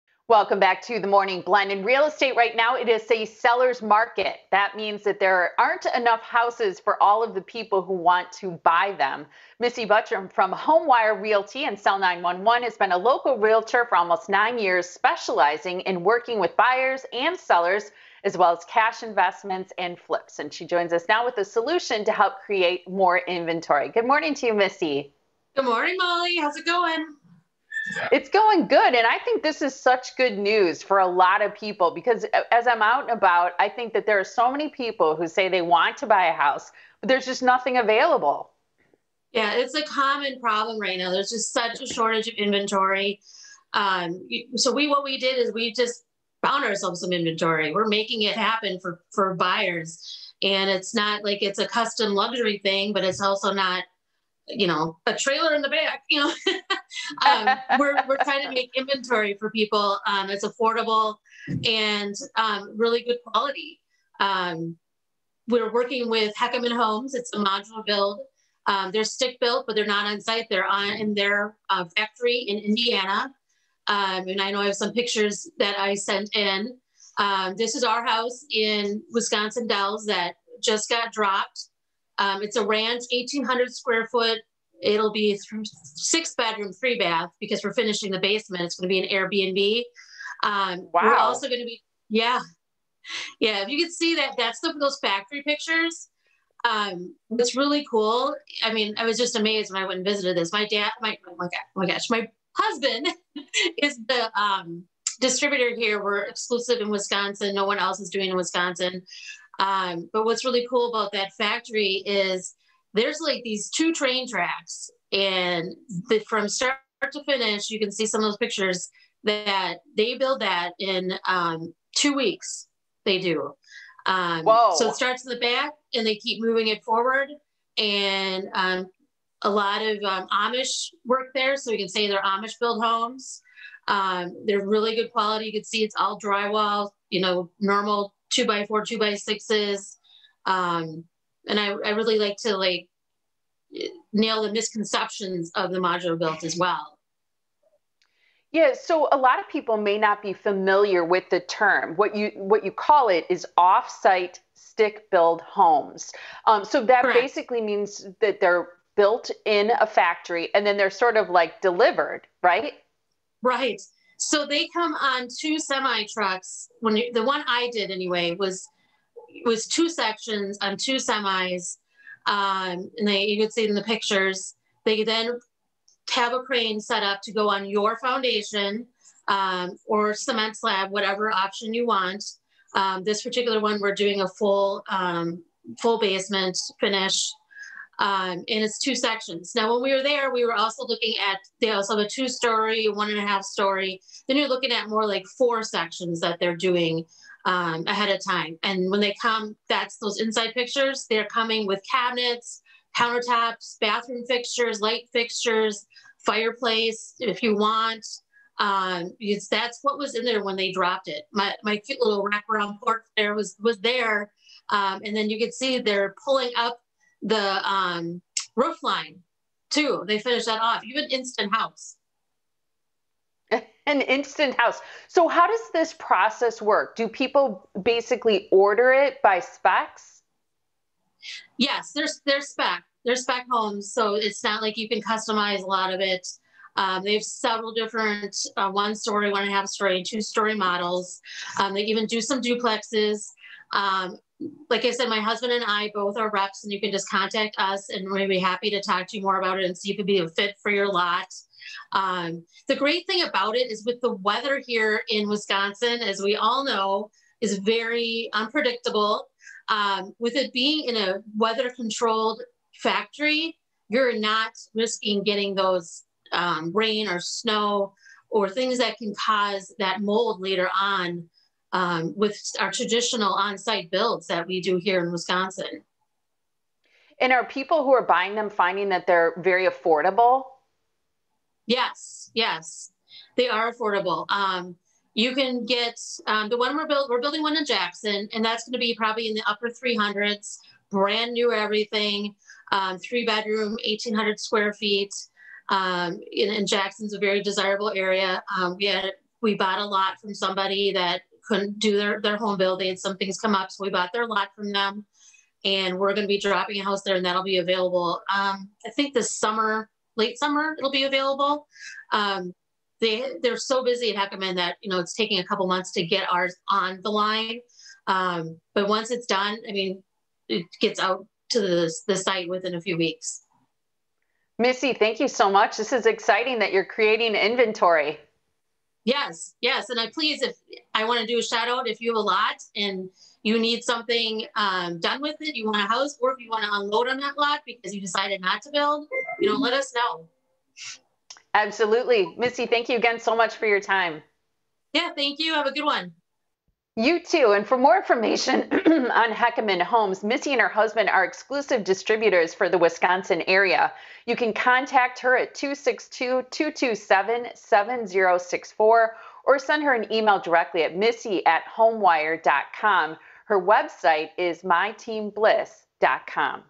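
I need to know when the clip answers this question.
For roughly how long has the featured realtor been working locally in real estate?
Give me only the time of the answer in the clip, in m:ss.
0:13.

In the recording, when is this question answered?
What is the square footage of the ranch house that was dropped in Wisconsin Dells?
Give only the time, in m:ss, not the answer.
1:23.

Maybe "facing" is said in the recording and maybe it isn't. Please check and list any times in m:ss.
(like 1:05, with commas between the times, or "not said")
not said.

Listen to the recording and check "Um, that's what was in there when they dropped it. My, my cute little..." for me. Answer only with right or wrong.
right.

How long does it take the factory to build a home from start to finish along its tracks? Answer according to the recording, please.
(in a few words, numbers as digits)
two weeks.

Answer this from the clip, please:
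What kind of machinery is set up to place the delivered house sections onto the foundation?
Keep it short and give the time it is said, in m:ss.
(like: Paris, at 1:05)
a crane, at 2:56.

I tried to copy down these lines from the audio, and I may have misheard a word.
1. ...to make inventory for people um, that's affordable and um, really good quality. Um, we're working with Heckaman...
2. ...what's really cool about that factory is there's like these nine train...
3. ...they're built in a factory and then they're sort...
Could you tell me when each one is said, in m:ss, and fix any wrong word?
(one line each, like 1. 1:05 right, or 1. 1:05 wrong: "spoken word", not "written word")
1. 0:58 right
2. 1:50 wrong: "two", not "nine"
3. 2:38 right.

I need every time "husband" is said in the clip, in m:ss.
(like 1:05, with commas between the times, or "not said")
1:42, 4:05, 5:50.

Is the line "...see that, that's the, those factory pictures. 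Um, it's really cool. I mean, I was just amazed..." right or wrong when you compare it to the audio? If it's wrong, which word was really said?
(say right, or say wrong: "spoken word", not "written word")
right.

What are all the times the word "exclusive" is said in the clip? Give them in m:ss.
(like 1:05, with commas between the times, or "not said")
1:46, 5:51.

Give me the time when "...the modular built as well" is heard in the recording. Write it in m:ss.
2:25.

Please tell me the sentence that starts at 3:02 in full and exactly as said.
Um, this particular one, we're doing a full um, full basement finish um, and it's two sections.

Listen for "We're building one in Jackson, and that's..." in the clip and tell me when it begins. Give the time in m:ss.
4:47.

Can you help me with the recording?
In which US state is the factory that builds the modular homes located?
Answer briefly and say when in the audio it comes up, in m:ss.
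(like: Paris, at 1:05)
Indiana, at 1:12.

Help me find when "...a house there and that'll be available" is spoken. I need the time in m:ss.
5:06.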